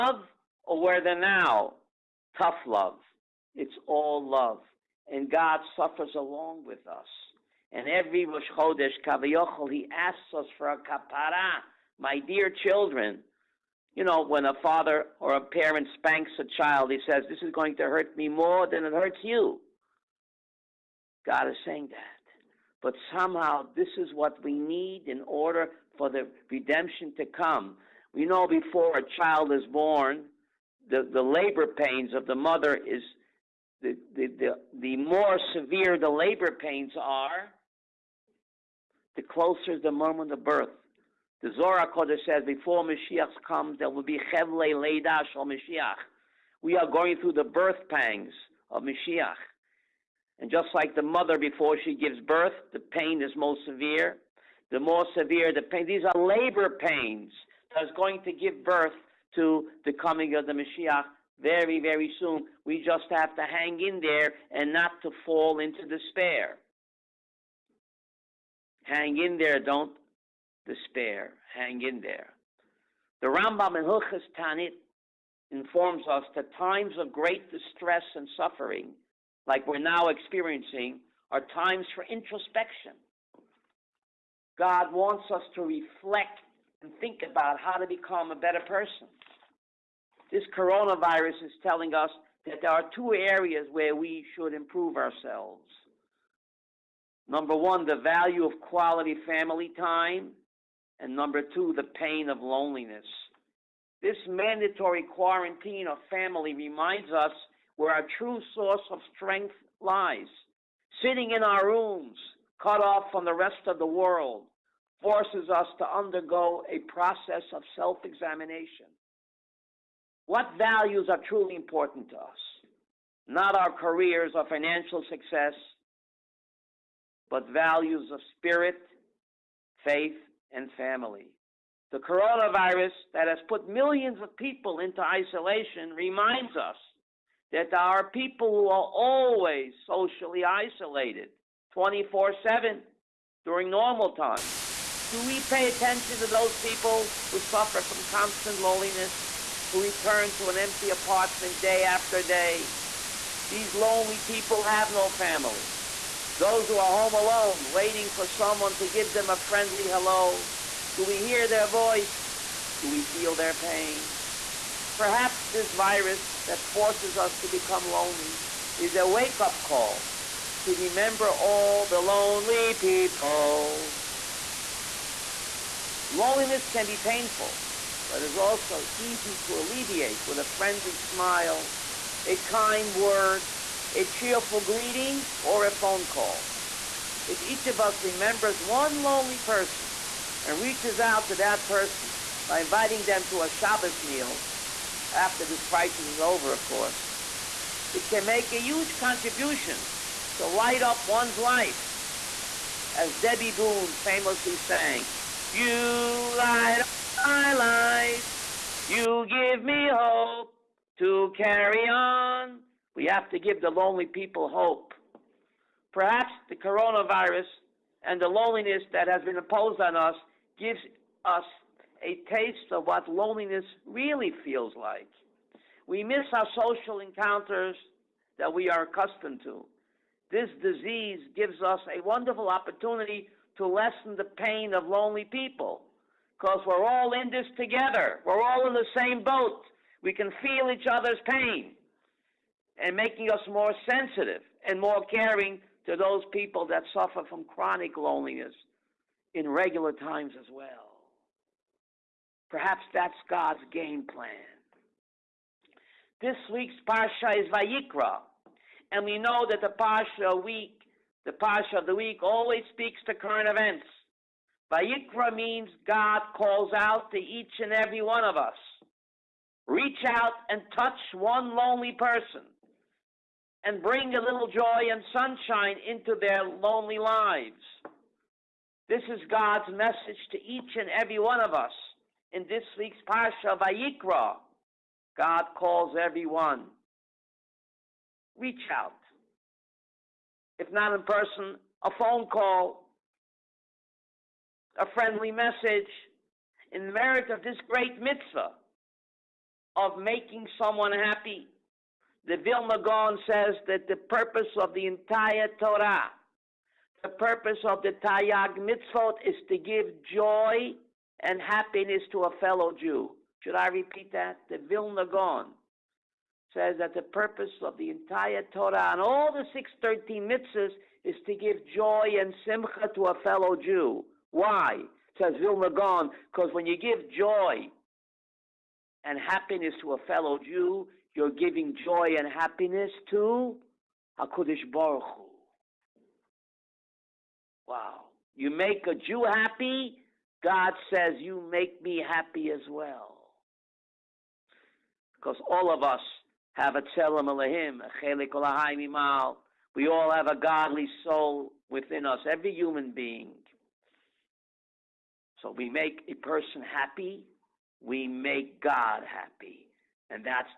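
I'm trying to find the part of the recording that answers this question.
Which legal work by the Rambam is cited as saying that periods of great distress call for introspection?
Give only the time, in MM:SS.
01:13.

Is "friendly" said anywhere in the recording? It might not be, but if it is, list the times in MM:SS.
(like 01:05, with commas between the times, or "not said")
02:39, 03:00, 04:54.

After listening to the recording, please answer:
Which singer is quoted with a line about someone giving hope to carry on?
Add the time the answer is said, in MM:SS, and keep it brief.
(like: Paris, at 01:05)
Debbie Boone, at 03:23.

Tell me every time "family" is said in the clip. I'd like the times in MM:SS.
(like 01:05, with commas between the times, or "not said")
01:39, 01:46, 02:10, 02:35.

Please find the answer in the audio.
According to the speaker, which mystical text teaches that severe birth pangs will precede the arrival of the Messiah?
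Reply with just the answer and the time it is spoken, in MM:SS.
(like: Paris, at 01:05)
Zohar Kodesh, at 00:41.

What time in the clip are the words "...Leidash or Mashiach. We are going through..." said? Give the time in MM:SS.
00:44.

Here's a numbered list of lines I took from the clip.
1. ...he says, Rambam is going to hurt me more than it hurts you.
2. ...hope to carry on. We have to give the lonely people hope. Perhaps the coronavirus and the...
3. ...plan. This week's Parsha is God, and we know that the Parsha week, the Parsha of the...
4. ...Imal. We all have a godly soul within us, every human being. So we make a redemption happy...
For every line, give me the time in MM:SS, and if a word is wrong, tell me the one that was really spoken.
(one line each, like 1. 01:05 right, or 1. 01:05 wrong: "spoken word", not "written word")
1. 00:16 wrong: "This", not "Rambam"
2. 03:29 right
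3. 04:14 wrong: "Vayikra", not "God"
4. 05:48 wrong: "person", not "redemption".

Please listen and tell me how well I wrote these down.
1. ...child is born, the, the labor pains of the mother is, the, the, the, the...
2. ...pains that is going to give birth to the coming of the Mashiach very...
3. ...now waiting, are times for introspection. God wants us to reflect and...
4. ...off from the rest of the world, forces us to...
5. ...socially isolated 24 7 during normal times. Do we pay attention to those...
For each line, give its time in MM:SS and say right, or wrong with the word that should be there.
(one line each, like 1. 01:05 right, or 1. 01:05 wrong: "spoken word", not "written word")
1. 00:29 right
2. 00:56 right
3. 01:19 wrong: "experiencing", not "waiting"
4. 01:52 right
5. 02:19 right.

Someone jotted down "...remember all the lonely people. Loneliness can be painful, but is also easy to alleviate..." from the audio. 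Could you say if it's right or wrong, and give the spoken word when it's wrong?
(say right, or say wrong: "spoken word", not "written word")
right.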